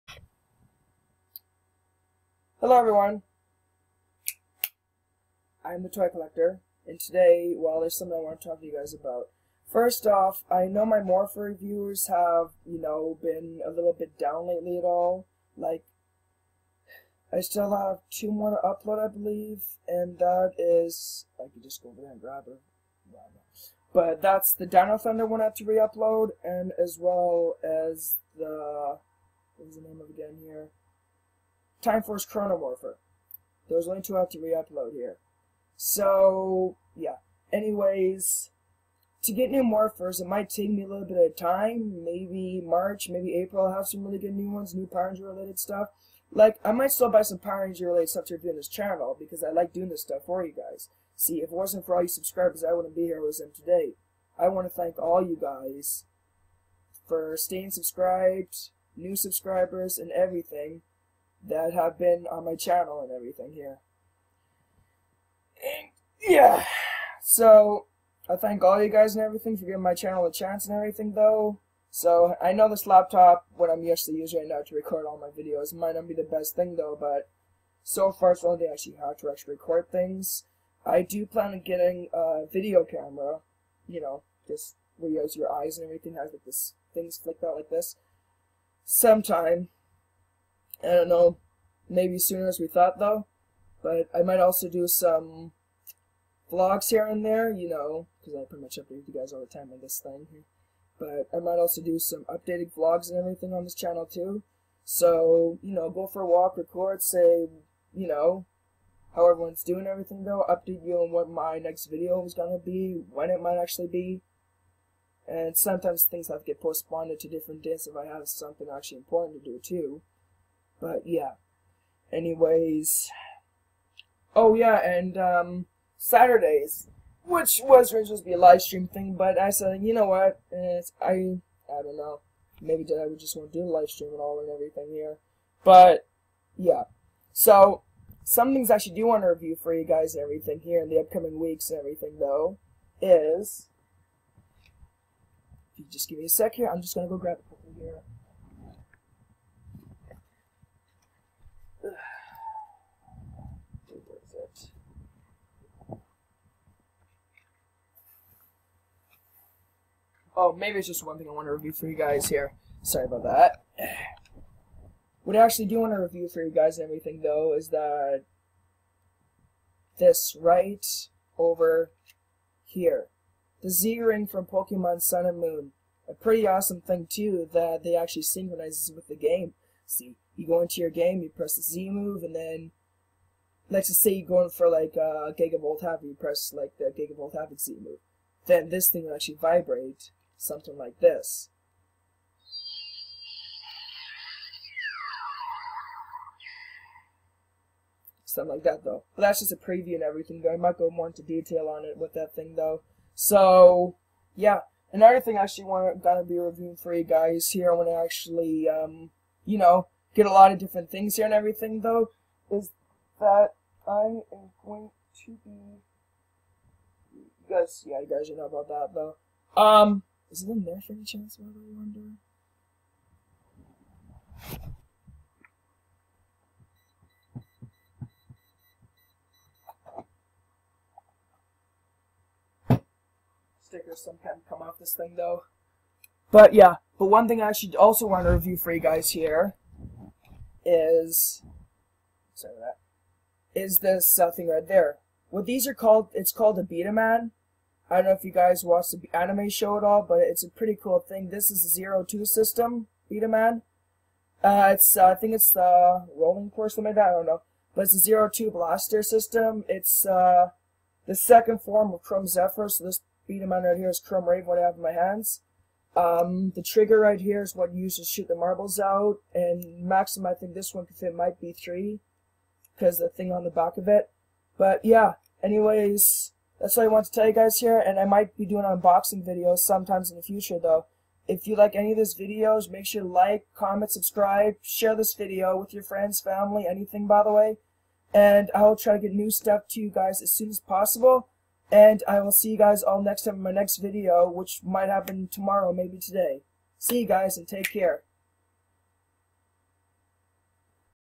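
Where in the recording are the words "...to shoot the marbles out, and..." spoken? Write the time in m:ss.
4:27.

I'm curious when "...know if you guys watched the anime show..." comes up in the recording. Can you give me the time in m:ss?
4:08.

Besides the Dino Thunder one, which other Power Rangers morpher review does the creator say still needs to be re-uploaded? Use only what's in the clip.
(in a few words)
Time Force Chrono Morpher.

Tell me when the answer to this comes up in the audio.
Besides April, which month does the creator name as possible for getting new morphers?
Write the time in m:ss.
0:42.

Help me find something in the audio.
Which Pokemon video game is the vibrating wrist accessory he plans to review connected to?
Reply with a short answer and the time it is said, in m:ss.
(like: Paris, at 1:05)
Pokemon Sun and Moon, at 2:54.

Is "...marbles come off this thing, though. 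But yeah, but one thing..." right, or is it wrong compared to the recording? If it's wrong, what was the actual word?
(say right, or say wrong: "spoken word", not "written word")
wrong: "sometimes", not "marbles".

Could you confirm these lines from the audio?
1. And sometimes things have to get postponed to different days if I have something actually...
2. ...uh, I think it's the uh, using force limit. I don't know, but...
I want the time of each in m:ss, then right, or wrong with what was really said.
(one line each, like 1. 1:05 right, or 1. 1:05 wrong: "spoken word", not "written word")
1. 1:55 right
2. 4:14 wrong: "rolling", not "using".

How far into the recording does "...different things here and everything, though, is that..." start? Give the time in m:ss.
3:30.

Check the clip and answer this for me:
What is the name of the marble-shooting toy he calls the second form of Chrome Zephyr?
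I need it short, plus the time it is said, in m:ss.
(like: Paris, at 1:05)
Chrome Raven, at 4:23.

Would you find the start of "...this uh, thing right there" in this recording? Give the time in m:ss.
4:03.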